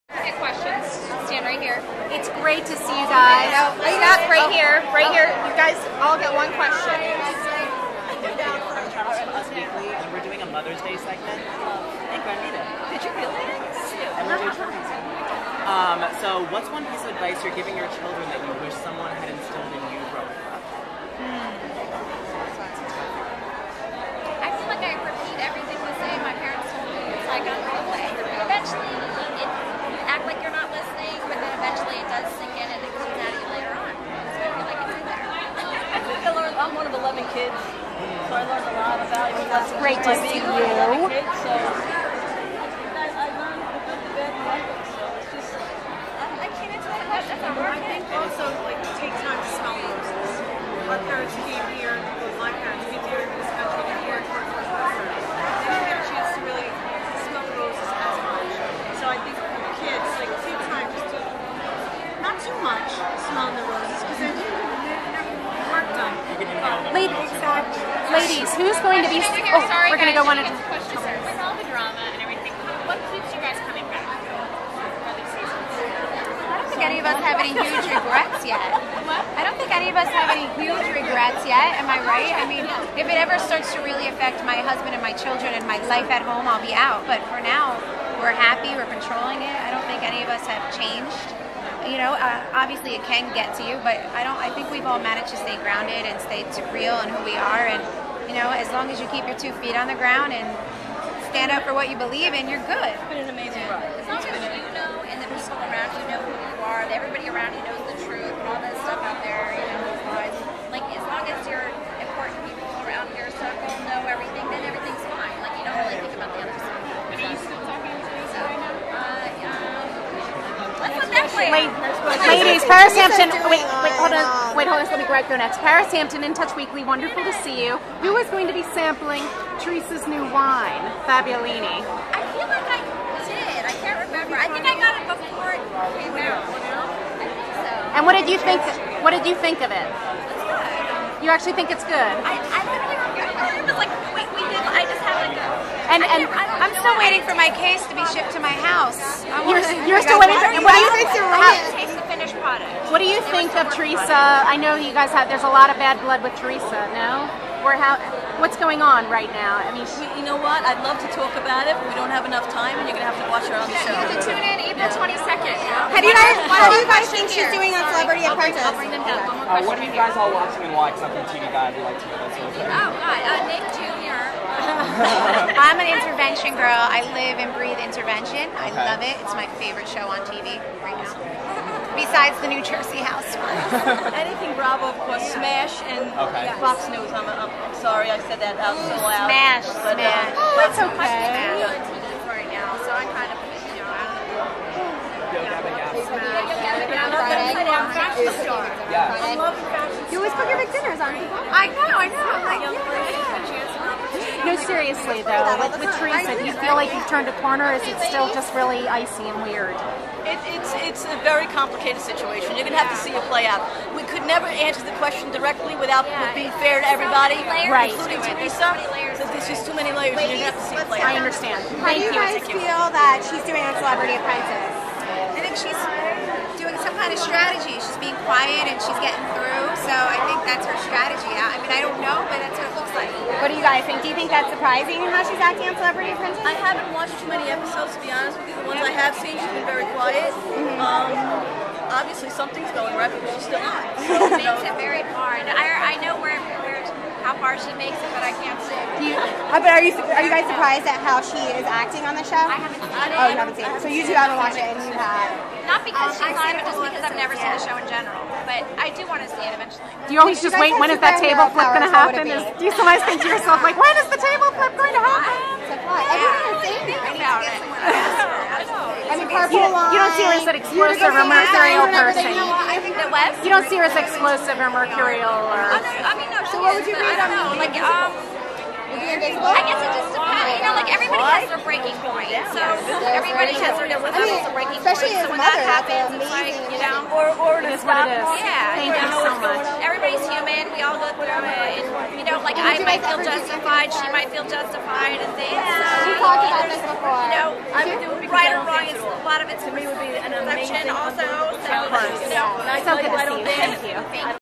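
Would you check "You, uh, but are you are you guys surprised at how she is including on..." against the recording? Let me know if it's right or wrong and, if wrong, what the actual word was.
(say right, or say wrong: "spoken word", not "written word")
wrong: "acting", not "including".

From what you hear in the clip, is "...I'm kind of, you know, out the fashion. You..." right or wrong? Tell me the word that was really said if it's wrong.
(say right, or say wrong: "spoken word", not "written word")
right.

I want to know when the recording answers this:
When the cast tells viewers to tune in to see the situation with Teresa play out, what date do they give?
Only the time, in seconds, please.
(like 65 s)
164 s.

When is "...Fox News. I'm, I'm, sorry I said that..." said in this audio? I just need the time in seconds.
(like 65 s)
186 s.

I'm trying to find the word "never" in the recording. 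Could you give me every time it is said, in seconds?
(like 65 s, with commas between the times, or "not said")
214 s, 257 s.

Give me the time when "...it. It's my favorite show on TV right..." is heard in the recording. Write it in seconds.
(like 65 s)
179 s.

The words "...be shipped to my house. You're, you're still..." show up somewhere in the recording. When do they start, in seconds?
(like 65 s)
147 s.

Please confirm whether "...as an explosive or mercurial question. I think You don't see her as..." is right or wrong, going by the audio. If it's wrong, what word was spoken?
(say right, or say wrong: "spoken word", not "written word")
wrong: "person", not "question".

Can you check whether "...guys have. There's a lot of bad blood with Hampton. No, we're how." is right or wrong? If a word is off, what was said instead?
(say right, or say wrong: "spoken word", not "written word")
wrong: "Teresa", not "Hampton".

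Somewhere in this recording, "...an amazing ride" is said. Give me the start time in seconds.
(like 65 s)
103 s.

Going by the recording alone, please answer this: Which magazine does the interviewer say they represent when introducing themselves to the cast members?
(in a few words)
In Touch Weekly.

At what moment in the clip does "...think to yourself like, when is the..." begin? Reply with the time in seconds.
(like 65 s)
263 s.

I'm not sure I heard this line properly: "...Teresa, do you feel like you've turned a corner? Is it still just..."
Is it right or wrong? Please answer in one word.
right.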